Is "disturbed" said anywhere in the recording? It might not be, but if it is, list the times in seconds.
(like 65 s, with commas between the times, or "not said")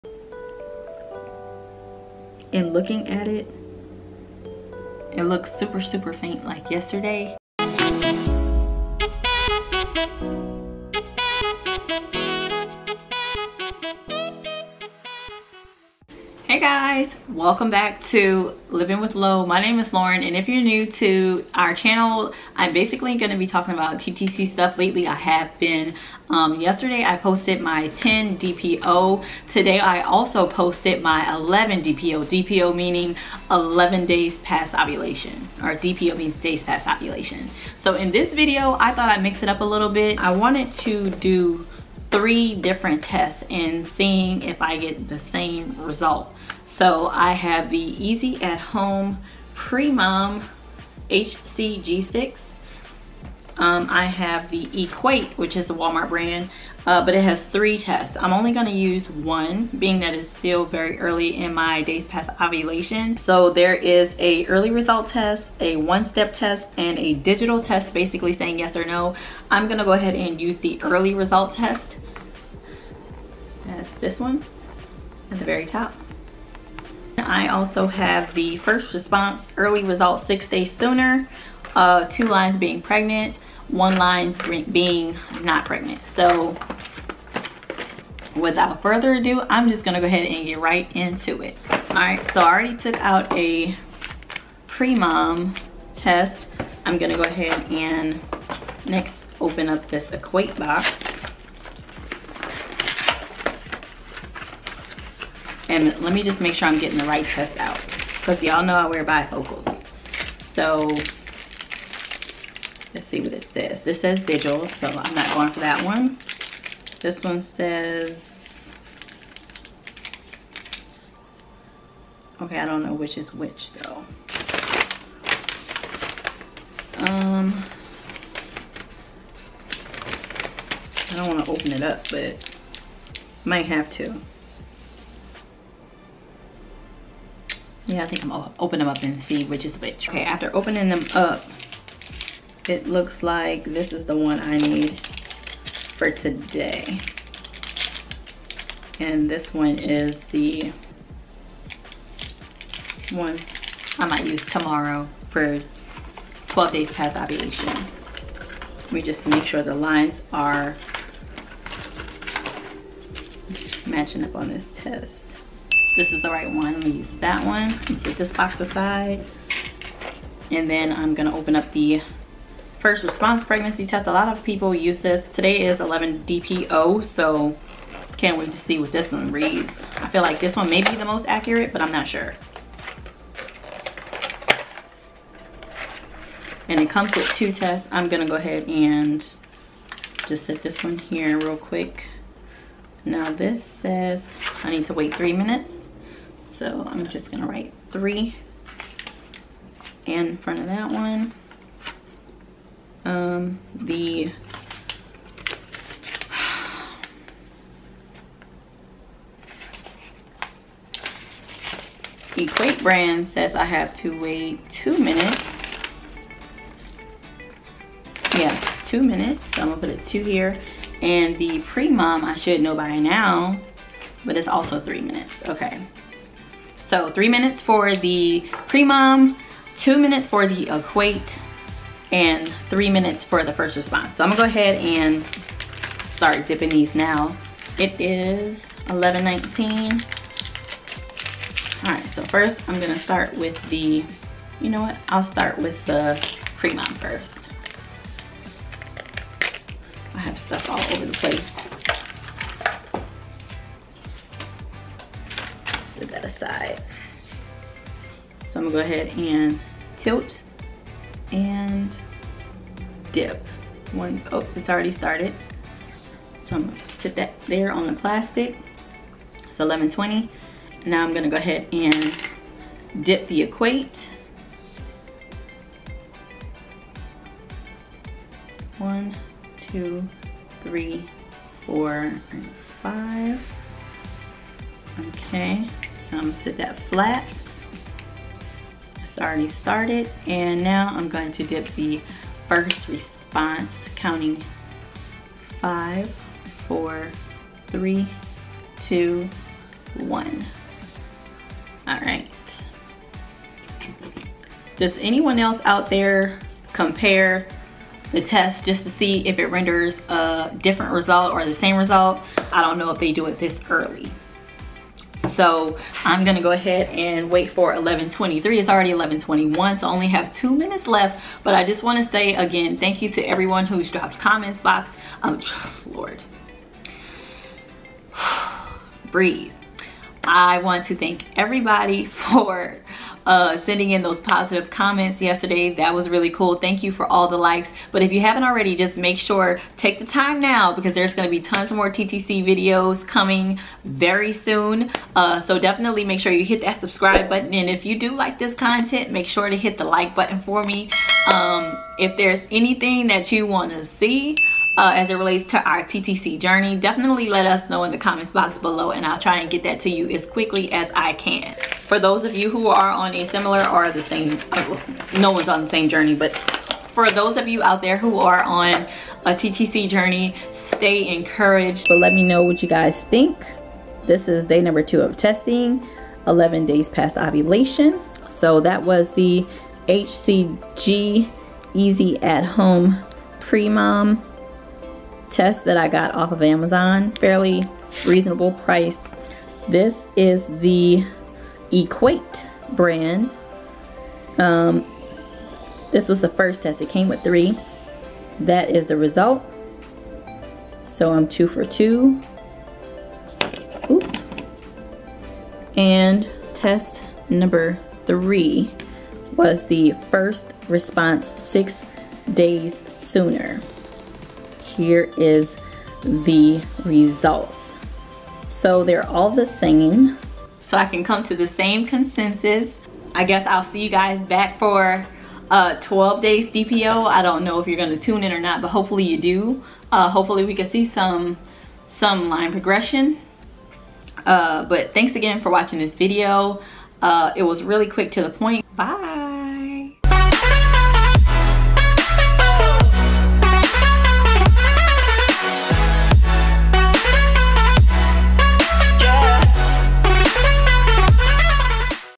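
not said.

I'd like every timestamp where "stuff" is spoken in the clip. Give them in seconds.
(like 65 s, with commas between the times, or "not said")
24 s, 250 s.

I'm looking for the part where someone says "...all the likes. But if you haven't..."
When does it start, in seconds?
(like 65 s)
337 s.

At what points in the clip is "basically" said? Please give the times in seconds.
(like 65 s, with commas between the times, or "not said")
22 s, 67 s.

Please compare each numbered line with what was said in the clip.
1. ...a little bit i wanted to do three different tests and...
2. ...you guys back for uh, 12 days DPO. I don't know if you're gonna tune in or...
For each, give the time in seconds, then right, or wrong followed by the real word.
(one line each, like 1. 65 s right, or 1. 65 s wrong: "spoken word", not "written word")
1. 39 s right
2. 423 s right.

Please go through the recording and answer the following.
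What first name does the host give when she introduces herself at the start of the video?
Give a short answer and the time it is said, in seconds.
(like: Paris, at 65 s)
Lauren, at 19 s.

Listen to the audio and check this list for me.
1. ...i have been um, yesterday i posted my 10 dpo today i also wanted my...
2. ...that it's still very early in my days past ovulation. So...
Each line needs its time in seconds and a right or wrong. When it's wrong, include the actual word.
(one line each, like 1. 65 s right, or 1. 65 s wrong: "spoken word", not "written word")
1. 25 s wrong: "posted", not "wanted"
2. 59 s right.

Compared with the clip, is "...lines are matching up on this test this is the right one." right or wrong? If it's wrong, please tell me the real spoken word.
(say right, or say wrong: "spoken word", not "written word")
right.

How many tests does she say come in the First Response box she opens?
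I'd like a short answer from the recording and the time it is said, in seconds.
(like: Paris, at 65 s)
2, at 187 s.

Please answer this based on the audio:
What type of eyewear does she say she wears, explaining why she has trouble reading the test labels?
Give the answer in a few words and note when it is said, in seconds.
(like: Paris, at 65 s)
Bifocals, at 109 s.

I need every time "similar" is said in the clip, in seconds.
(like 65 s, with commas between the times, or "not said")
363 s.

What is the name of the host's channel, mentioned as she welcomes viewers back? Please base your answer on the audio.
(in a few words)
Living with Lo.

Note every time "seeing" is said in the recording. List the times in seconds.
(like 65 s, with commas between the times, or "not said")
43 s.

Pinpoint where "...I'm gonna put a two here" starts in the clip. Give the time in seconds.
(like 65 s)
219 s.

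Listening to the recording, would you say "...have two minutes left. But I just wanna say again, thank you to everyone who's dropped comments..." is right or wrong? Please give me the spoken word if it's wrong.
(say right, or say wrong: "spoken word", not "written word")
right.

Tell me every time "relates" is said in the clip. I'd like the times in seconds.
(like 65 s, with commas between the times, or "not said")
355 s.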